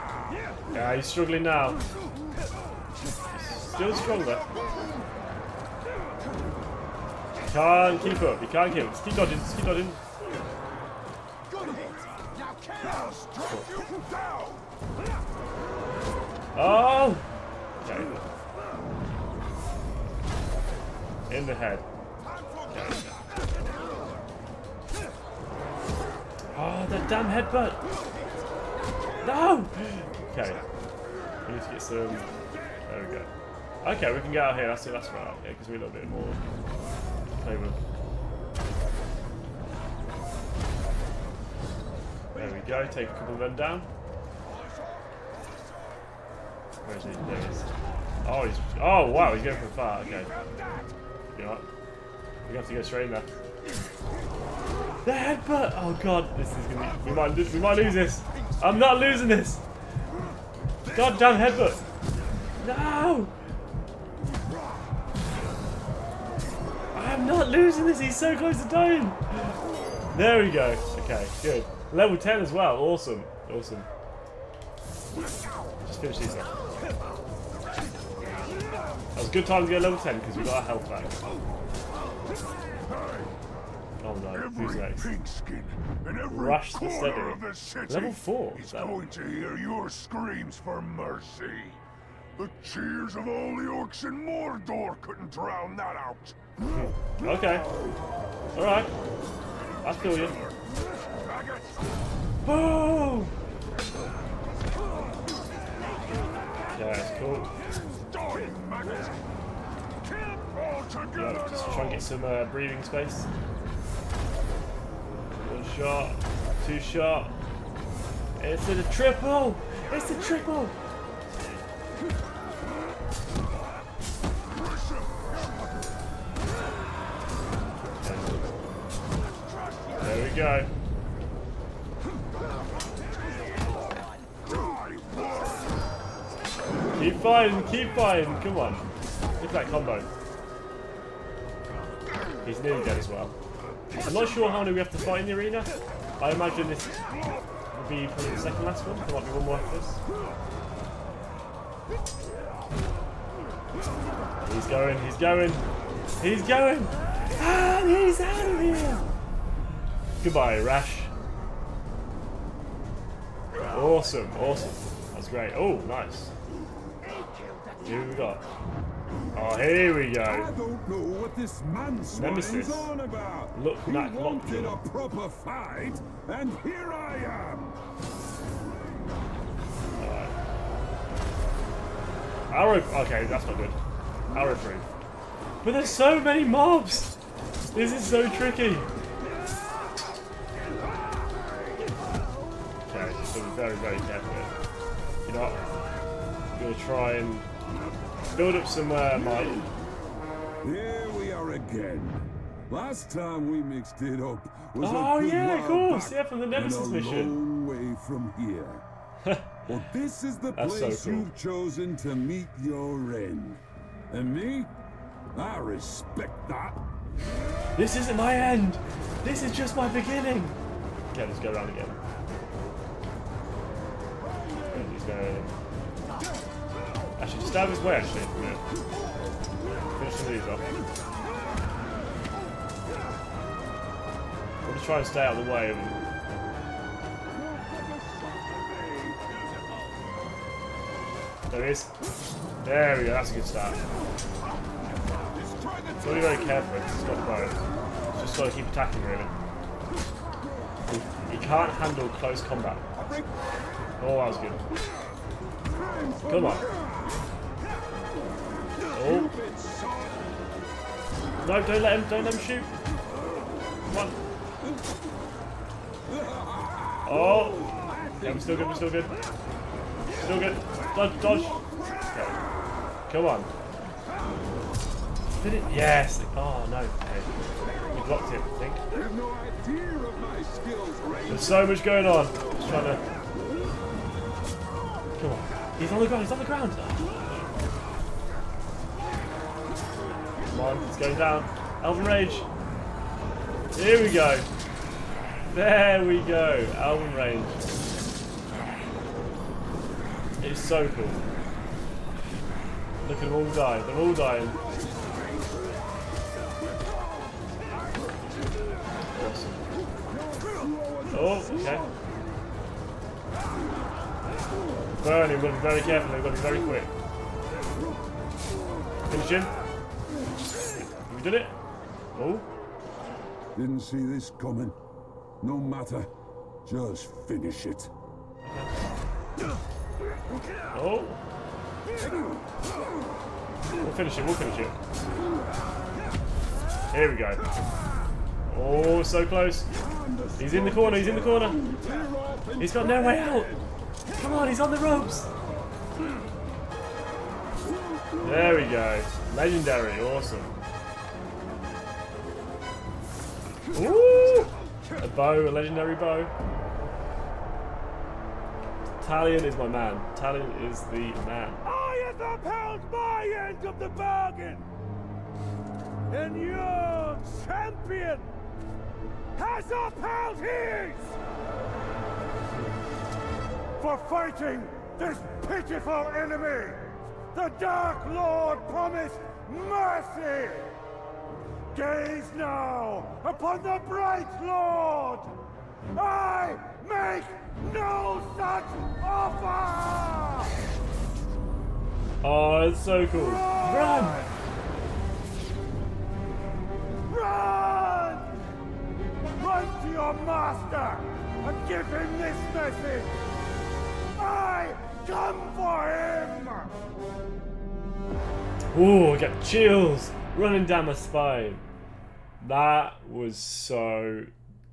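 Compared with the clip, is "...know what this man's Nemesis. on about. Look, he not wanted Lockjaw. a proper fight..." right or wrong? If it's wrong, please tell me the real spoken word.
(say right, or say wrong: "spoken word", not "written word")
right.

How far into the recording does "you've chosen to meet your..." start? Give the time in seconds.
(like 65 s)
211 s.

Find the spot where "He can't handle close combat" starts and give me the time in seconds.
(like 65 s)
251 s.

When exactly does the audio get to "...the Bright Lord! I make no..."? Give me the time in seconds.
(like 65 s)
383 s.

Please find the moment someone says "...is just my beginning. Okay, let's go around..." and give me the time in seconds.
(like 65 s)
219 s.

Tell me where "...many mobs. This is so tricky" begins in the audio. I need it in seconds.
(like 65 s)
186 s.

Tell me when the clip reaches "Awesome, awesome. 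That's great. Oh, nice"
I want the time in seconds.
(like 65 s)
163 s.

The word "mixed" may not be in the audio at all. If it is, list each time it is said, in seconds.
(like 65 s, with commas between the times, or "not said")
203 s.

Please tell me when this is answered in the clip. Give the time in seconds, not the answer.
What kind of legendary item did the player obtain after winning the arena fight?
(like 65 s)
355 s.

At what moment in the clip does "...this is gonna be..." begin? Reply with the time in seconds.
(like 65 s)
56 s.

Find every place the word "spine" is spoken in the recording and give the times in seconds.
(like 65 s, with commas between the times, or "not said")
410 s.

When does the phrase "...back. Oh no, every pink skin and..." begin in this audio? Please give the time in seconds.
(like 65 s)
80 s.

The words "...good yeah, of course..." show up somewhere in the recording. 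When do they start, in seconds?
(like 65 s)
205 s.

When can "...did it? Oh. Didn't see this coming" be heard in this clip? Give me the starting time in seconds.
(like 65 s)
321 s.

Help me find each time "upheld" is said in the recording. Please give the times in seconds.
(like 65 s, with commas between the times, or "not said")
362 s, 369 s.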